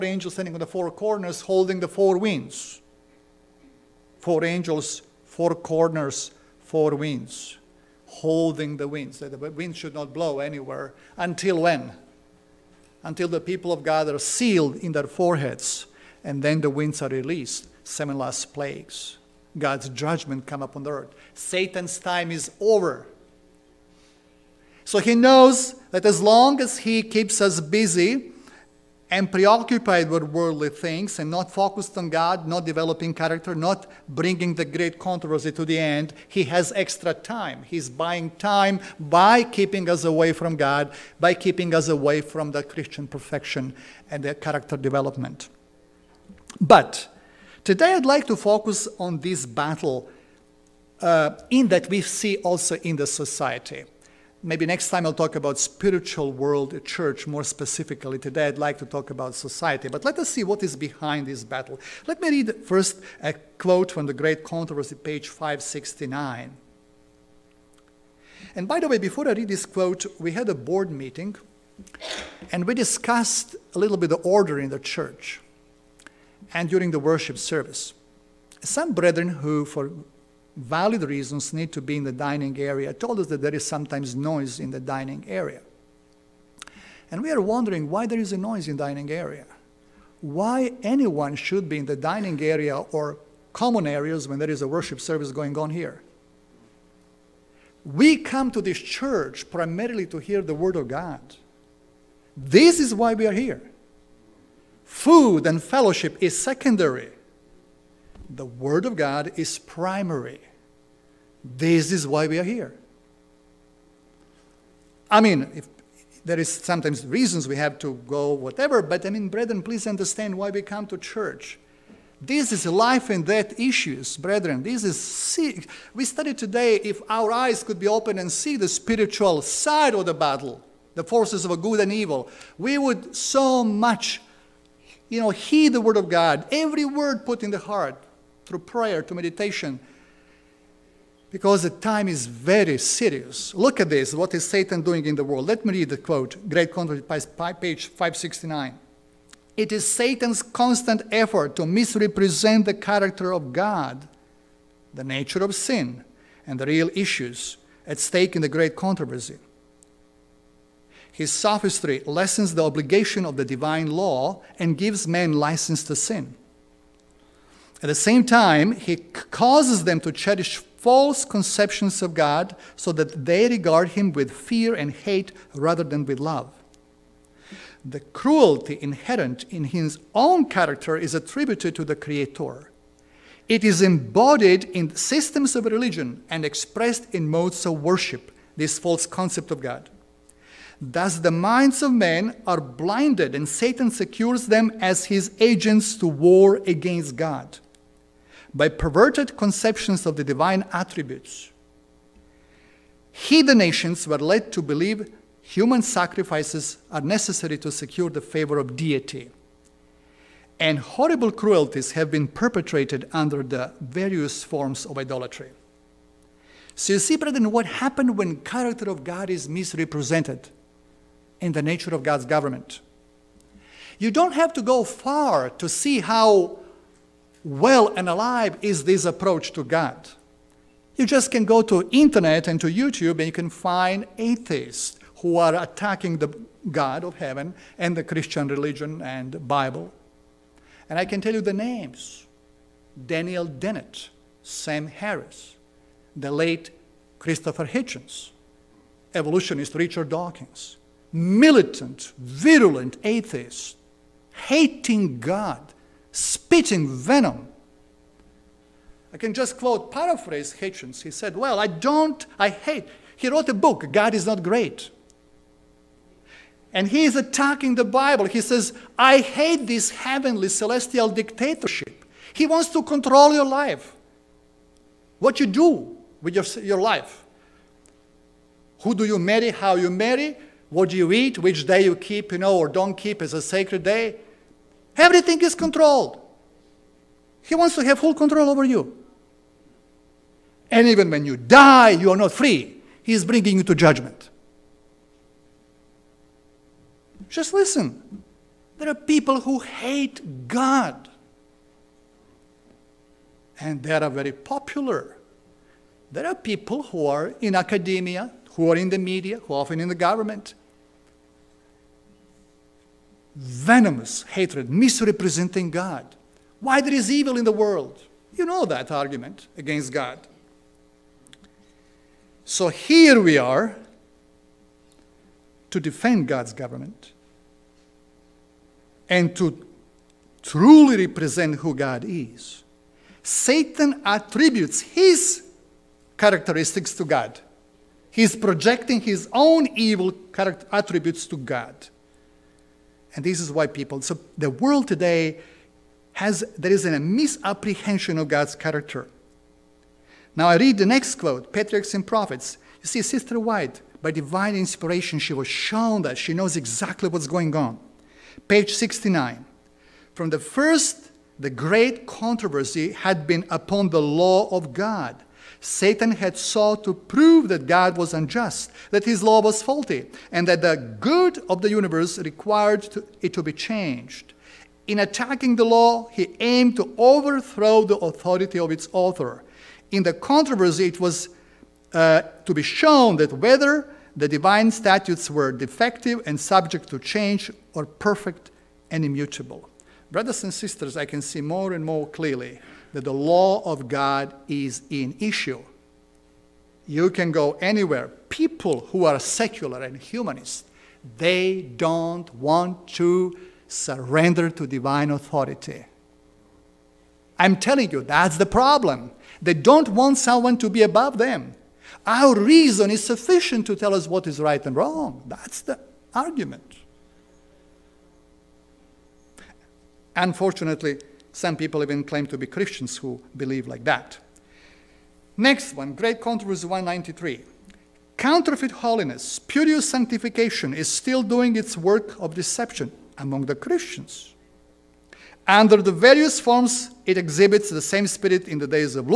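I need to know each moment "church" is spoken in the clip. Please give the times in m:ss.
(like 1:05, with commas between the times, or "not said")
0:56, 1:14, 1:38, 2:00.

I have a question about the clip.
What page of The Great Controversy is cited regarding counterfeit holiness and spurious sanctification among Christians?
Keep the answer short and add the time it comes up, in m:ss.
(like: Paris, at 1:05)
193, at 7:06.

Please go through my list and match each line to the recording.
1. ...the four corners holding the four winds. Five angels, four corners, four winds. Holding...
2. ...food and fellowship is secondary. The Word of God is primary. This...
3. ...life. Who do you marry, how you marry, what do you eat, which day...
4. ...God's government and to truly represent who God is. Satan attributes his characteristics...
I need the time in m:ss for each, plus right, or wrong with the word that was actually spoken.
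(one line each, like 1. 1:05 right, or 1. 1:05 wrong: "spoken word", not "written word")
1. 0:00 wrong: "Four", not "Five"
2. 1:44 right
3. 4:36 right
4. 5:26 right.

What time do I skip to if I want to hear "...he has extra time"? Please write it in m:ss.
0:36.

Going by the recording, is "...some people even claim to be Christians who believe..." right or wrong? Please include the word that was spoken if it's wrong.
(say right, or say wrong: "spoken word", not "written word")
right.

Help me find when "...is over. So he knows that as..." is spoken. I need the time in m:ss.
0:22.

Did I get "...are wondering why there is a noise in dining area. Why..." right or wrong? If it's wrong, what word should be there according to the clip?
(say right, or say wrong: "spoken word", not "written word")
right.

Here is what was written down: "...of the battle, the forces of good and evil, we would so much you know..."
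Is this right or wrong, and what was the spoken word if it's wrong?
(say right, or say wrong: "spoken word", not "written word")
right.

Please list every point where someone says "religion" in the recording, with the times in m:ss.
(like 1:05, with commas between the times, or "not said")
3:05, 3:58.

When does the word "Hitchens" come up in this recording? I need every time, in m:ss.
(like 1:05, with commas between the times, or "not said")
4:07, 4:20.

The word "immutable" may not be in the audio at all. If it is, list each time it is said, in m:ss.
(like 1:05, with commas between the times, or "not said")
6:29.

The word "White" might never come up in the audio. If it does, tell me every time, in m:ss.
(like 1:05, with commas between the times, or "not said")
5:53.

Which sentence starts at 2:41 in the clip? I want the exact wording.
His sophistry lessens the obligation of the divine law and gives men license to sin.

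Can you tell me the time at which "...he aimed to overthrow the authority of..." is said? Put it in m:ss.
6:16.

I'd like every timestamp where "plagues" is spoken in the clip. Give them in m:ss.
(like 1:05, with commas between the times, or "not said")
0:18.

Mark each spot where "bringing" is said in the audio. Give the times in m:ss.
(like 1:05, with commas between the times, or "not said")
0:34, 4:53.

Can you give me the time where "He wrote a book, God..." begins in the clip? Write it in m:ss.
4:23.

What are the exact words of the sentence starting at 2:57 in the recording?
The cruelty inherent in his own character is attributed to the Creator.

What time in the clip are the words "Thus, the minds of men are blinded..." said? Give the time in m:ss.
3:10.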